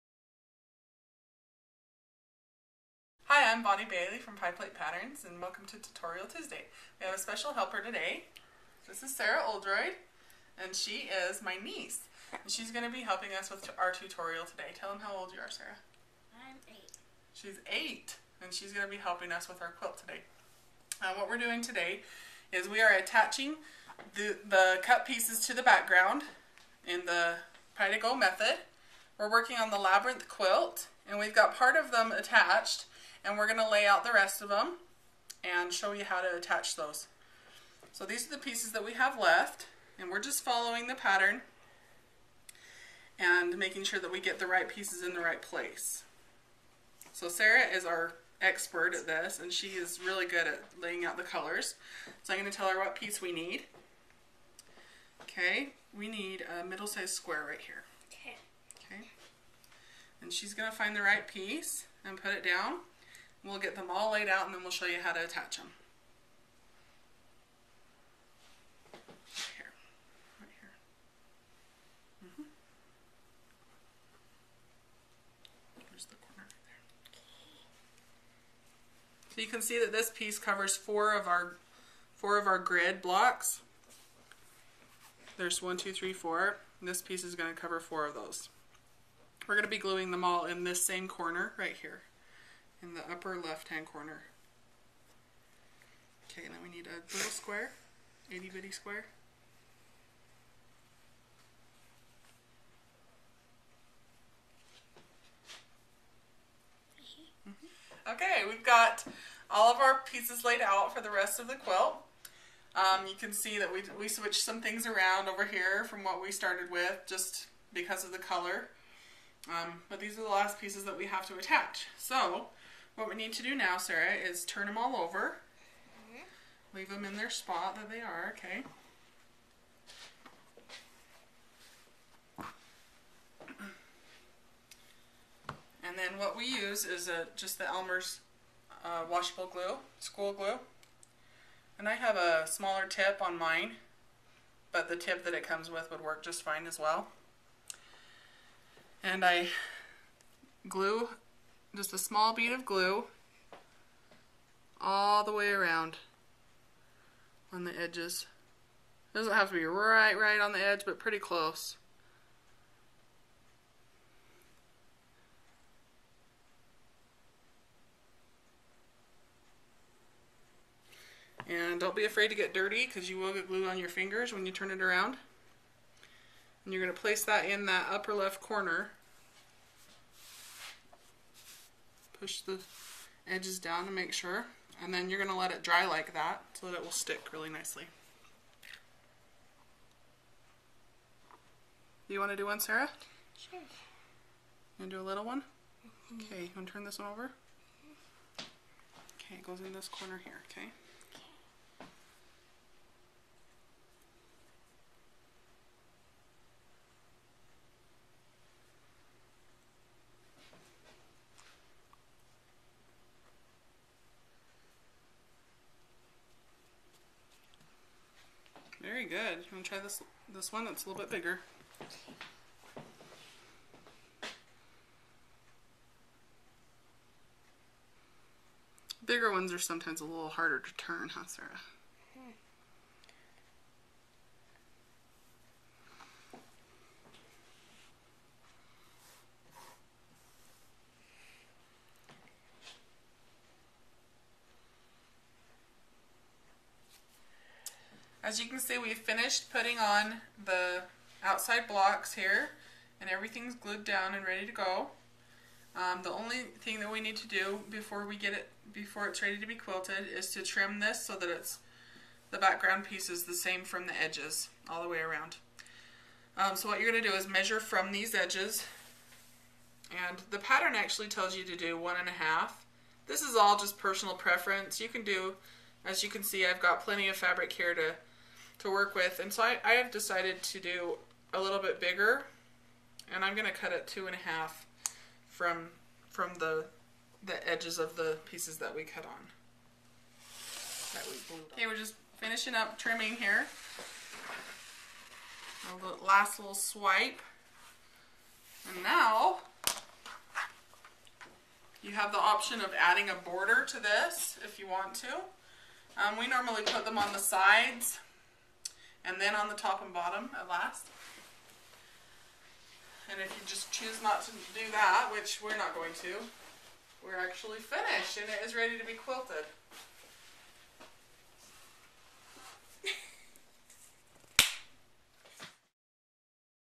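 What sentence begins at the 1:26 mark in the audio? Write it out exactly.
And this piece is going to cover four of those.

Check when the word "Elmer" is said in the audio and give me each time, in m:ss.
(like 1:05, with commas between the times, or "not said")
2:17.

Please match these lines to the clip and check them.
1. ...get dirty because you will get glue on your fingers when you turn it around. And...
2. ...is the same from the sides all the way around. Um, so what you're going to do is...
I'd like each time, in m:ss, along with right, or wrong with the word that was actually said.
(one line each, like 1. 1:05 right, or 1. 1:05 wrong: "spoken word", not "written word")
1. 2:52 right
2. 4:23 wrong: "edges", not "sides".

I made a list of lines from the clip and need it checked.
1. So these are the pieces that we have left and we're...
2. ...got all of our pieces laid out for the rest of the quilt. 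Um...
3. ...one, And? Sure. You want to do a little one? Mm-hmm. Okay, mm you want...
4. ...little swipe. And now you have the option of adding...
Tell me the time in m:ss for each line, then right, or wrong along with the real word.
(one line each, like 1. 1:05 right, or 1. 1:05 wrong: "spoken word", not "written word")
1. 0:37 right
2. 1:48 right
3. 3:12 wrong: "Sarah", not "And"
4. 4:56 right.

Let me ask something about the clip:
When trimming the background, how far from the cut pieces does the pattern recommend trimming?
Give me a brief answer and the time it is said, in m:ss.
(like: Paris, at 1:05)
1.5, at 4:31.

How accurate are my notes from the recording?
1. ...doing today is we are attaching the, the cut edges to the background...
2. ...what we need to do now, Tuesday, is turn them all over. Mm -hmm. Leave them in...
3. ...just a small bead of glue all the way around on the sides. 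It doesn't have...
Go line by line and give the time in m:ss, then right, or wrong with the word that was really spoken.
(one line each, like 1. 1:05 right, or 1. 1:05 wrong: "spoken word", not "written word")
1. 0:21 wrong: "pieces", not "edges"
2. 2:02 wrong: "Sarah", not "Tuesday"
3. 2:31 wrong: "edges", not "sides".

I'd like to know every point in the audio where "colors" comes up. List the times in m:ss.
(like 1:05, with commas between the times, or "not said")
0:51, 1:58.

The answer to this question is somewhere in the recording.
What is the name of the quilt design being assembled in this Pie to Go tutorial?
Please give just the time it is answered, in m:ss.
0:29.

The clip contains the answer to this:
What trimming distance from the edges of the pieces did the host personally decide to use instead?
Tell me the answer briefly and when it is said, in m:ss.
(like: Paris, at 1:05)
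2.5, at 4:43.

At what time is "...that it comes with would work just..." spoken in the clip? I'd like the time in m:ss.
2:25.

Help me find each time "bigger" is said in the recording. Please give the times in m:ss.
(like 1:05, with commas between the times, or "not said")
3:41, 3:49, 4:41.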